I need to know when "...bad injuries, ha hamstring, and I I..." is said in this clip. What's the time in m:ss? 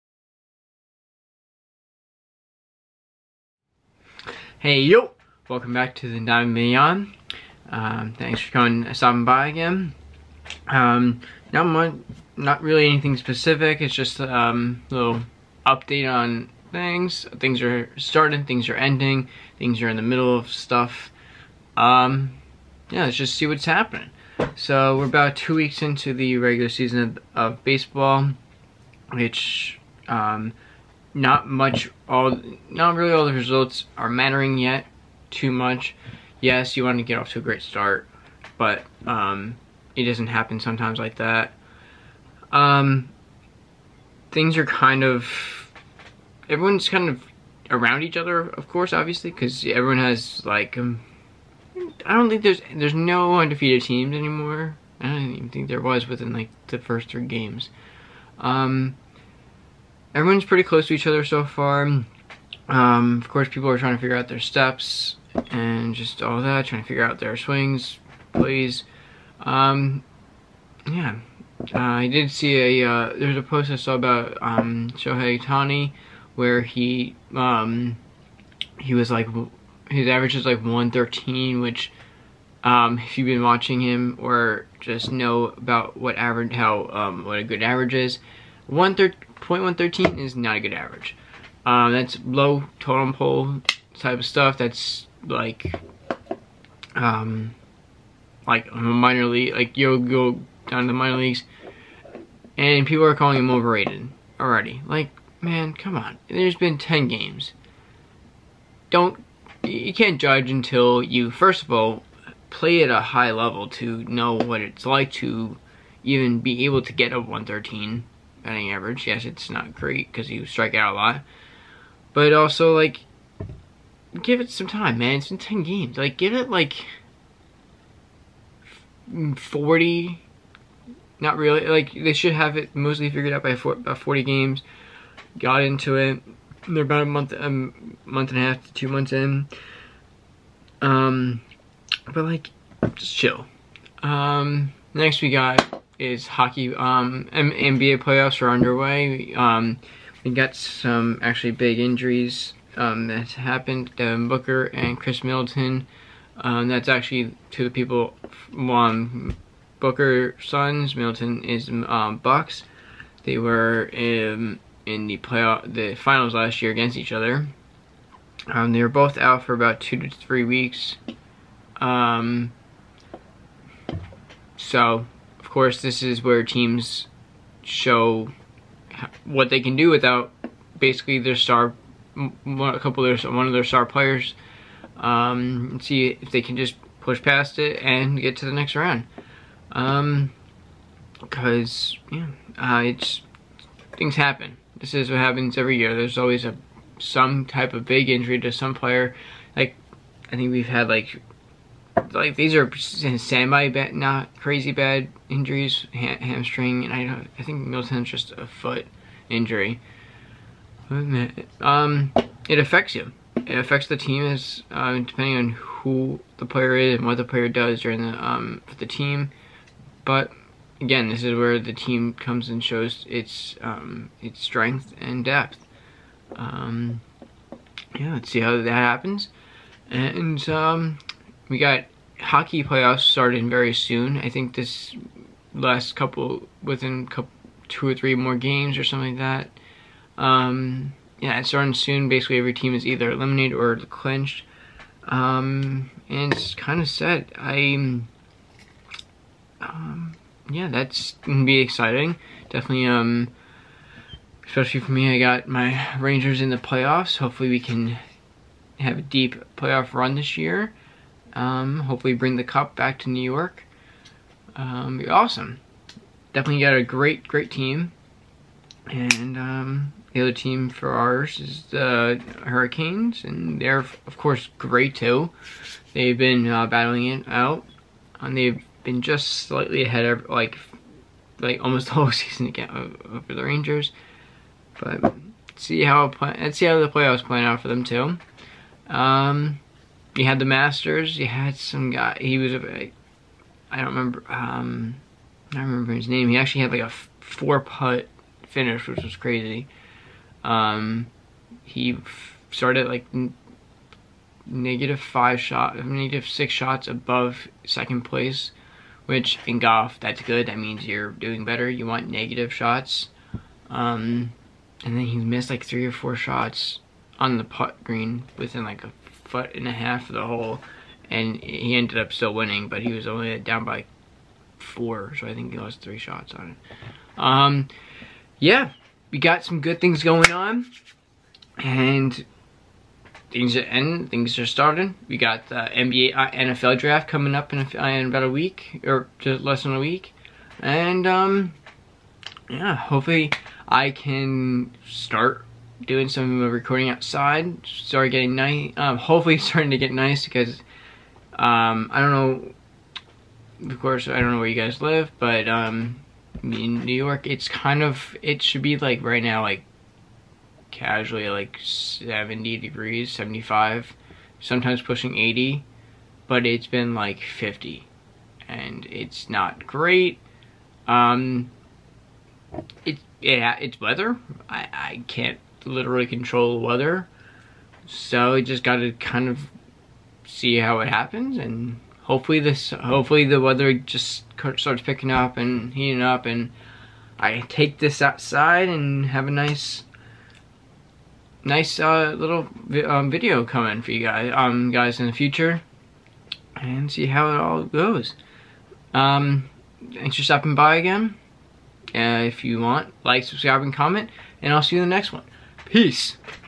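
3:24.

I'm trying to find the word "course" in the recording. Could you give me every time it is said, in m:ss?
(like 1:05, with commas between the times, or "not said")
0:48, 1:03, 2:55, 4:34, 5:53.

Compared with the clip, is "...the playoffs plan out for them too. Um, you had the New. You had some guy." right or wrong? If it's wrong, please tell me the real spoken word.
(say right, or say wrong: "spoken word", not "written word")
wrong: "Masters", not "New".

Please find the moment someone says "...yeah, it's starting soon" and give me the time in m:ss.
4:01.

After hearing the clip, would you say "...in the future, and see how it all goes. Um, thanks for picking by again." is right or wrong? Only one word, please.
wrong.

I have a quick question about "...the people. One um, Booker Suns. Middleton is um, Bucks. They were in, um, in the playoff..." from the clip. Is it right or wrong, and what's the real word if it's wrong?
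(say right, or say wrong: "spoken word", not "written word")
right.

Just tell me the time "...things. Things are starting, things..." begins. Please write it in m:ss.
0:16.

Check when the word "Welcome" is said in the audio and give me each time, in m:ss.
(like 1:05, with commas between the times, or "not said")
0:05.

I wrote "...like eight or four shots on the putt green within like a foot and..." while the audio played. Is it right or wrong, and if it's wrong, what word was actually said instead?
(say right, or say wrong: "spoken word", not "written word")
wrong: "three", not "eight".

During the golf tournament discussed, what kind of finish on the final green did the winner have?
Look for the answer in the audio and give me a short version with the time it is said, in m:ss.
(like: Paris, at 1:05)
four putt, at 4:57.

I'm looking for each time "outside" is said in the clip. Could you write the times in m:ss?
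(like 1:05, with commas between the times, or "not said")
5:46, 6:28.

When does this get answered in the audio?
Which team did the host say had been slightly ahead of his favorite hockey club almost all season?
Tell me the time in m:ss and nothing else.
4:32.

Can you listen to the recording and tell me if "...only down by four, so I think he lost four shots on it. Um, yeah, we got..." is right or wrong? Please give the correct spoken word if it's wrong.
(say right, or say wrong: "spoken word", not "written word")
wrong: "three", not "four".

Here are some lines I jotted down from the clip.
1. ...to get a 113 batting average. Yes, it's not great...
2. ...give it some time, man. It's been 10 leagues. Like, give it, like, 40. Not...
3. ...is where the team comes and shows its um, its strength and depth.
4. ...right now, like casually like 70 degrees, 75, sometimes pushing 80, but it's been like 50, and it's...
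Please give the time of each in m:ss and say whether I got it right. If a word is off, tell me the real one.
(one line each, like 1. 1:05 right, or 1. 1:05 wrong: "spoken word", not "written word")
1. 1:56 right
2. 2:04 wrong: "games", not "leagues"
3. 3:41 right
4. 5:59 right.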